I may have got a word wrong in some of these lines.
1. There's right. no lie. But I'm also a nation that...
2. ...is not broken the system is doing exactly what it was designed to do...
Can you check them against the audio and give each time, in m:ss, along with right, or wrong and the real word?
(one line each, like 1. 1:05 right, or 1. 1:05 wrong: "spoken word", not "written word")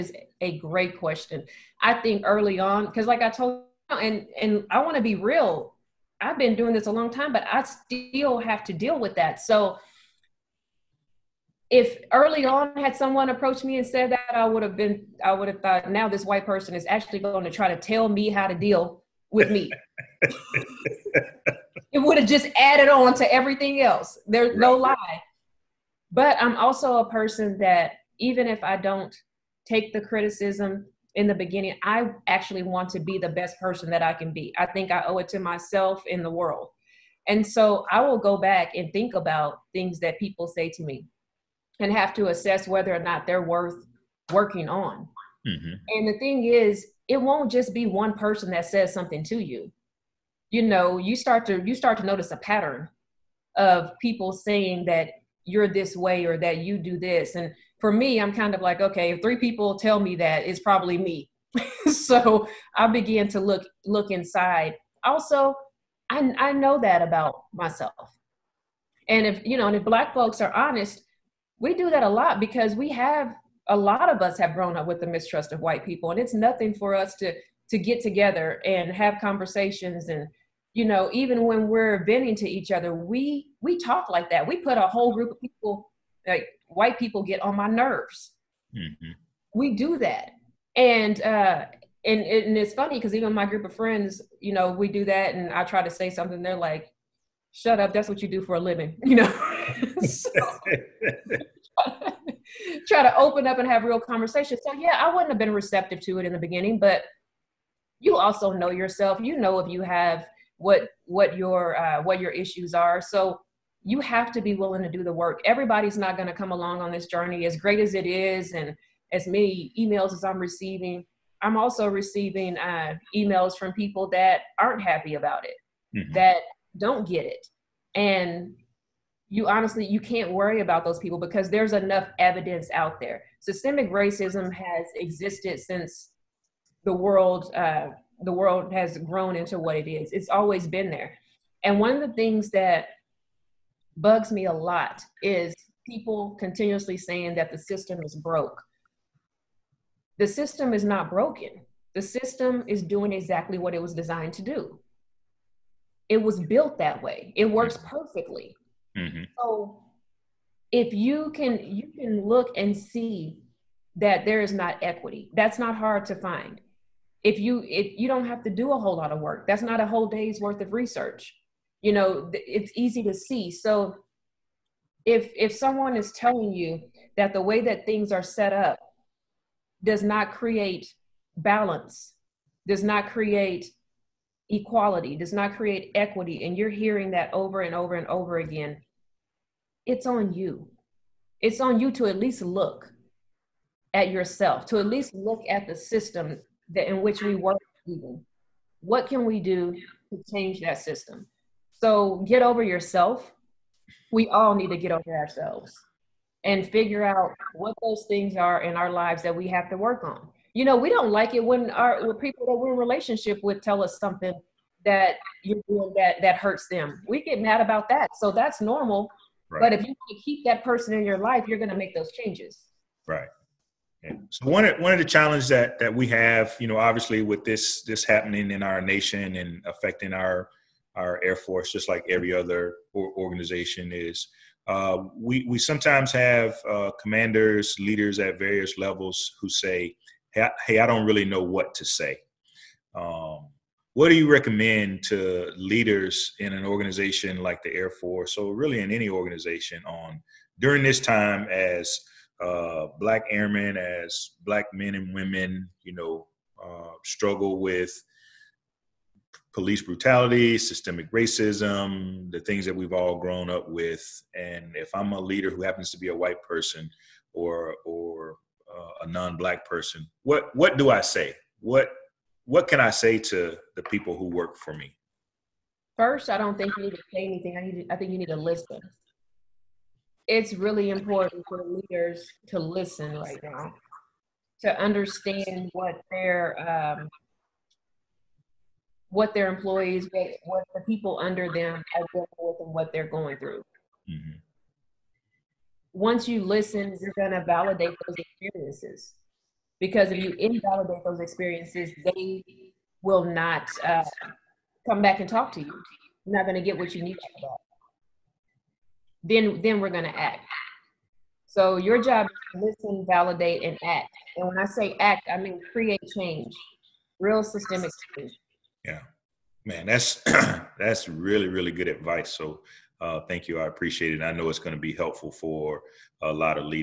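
1. 0:24 wrong: "person", not "nation"
2. 2:30 right.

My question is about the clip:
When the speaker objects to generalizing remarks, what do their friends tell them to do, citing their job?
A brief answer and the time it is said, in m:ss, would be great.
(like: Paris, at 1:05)
Shut up, at 1:37.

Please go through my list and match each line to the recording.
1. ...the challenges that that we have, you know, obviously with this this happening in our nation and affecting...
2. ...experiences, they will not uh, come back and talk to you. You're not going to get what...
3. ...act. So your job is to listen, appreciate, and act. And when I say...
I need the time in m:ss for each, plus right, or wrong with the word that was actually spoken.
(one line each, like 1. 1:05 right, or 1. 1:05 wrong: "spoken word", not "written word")
1. 3:44 right
2. 5:01 right
3. 5:10 wrong: "validate", not "appreciate".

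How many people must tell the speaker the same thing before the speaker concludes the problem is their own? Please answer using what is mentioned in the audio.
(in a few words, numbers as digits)
3.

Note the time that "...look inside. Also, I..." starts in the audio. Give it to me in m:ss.
1:03.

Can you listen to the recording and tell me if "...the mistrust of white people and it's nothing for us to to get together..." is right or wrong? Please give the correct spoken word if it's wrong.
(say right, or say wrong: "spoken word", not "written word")
right.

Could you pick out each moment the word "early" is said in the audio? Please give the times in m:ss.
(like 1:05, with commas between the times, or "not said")
0:02, 0:12.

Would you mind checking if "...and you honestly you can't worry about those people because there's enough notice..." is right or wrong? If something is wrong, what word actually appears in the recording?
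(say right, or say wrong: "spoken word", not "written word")
wrong: "evidence", not "notice".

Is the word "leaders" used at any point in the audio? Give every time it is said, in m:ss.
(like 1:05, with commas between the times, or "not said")
3:57, 4:05, 4:25, 4:41.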